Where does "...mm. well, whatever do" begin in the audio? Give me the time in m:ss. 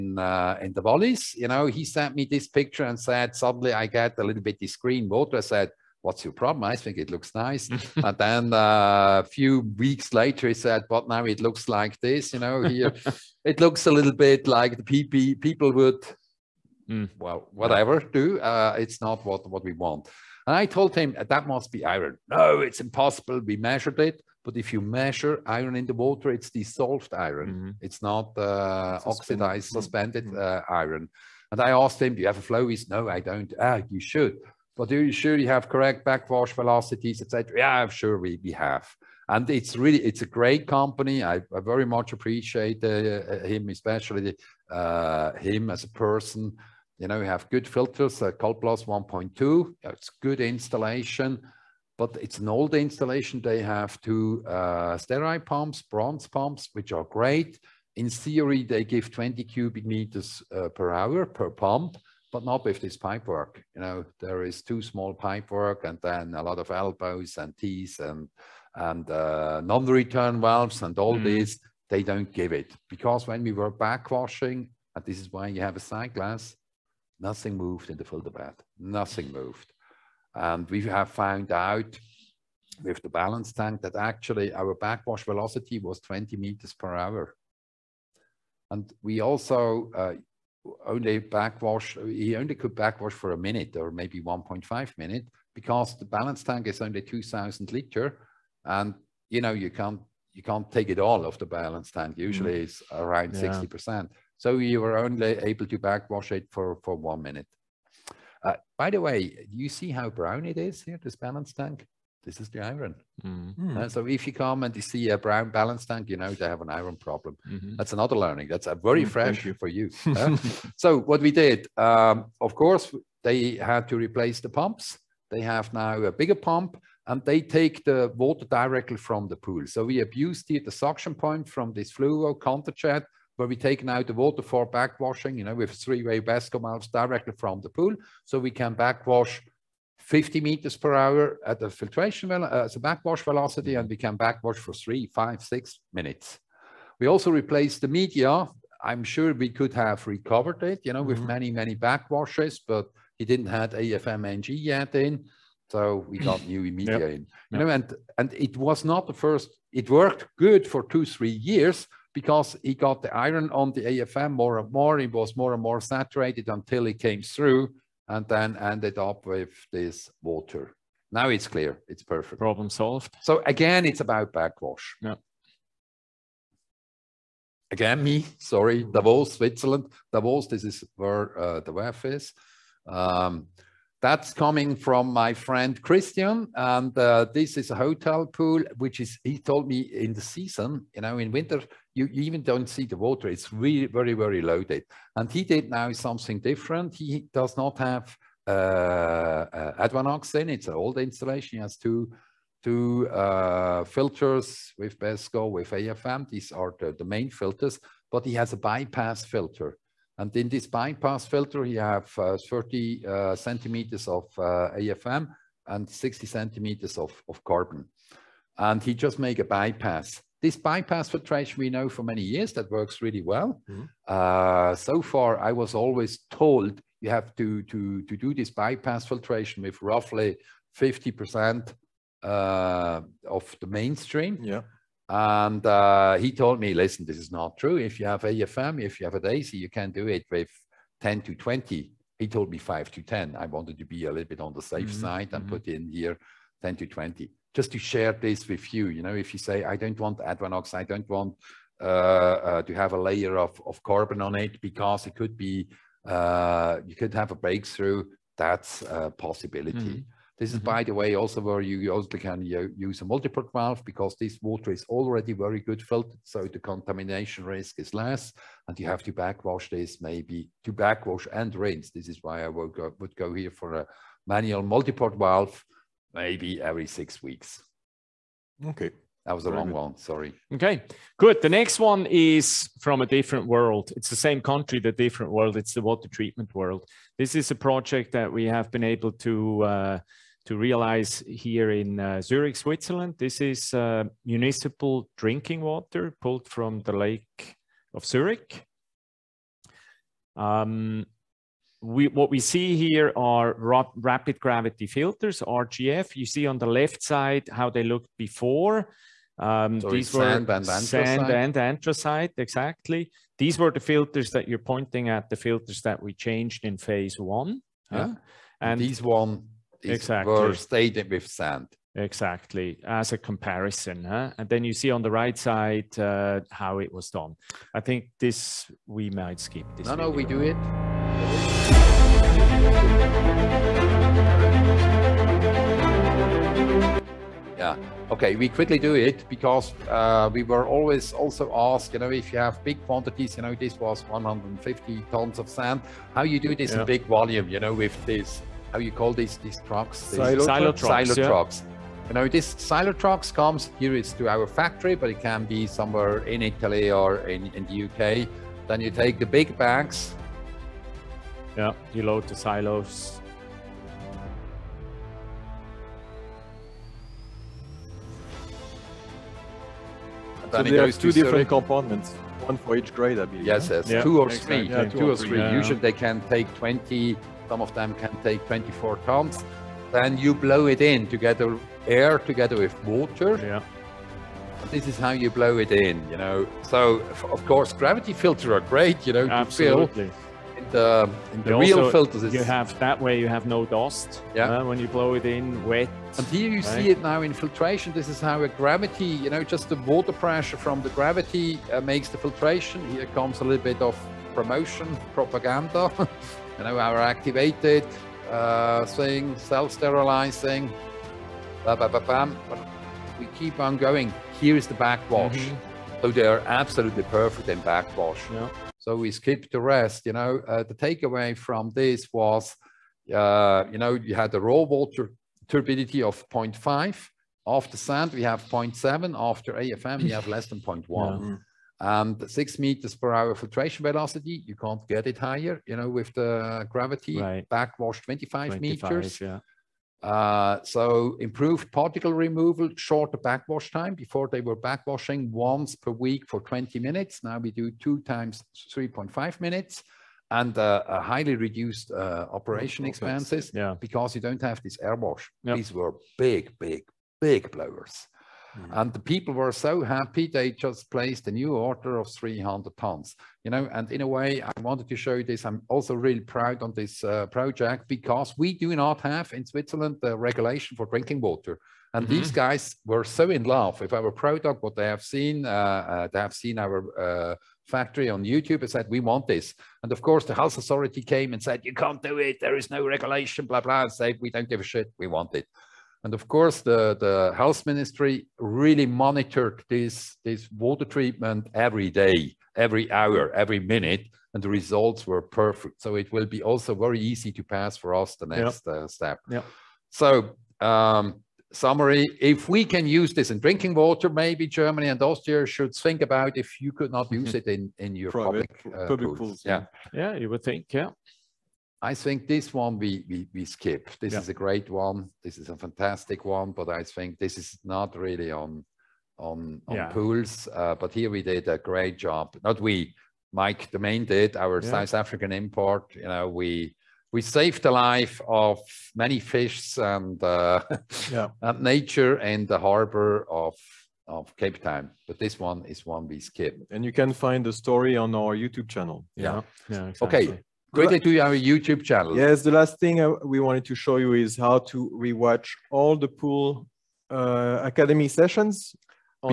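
0:16.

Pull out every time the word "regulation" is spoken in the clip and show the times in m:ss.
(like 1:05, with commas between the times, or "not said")
7:50, 8:02.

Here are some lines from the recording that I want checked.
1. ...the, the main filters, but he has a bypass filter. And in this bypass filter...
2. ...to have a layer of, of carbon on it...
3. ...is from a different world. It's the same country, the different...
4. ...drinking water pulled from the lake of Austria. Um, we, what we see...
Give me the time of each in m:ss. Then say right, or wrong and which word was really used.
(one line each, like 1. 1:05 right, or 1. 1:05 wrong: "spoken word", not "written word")
1. 3:26 right
2. 4:12 right
3. 4:42 right
4. 4:55 wrong: "Zurich", not "Austria".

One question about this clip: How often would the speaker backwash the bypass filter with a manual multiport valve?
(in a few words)
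every 6 weeks.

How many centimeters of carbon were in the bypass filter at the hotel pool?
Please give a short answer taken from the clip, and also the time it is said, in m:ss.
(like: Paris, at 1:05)
60, at 3:35.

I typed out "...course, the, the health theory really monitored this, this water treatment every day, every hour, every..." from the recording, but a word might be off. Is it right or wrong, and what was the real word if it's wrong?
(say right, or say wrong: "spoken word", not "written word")
wrong: "ministry", not "theory".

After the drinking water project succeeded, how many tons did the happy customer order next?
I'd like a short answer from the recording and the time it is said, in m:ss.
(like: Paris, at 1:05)
300, at 7:42.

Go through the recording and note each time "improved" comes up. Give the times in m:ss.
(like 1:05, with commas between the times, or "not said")
7:21.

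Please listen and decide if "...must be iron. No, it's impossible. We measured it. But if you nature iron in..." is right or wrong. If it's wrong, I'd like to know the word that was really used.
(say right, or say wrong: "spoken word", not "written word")
wrong: "measure", not "nature".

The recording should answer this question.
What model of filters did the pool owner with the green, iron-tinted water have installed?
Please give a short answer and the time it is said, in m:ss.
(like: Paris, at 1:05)
CalPlus 1.2, at 0:48.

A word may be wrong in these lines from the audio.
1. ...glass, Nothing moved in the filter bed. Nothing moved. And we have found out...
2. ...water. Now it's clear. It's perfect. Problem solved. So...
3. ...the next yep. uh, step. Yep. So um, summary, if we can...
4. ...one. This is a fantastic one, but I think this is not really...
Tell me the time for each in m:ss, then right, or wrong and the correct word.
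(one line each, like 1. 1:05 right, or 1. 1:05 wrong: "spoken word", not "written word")
1. 1:16 right
2. 2:50 right
3. 8:18 right
4. 8:34 right.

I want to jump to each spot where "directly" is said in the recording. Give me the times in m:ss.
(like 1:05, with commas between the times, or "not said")
2:08, 2:16.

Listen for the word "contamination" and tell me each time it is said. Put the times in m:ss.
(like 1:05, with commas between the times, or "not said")
4:26.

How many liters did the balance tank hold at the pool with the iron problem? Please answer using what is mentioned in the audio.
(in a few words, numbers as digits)
2000.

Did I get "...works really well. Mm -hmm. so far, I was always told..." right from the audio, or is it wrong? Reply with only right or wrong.
right.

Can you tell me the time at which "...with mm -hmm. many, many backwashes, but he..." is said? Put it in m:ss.
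2:31.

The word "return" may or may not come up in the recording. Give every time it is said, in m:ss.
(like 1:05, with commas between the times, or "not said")
1:09.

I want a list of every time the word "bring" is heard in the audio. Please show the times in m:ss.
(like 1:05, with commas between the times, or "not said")
not said.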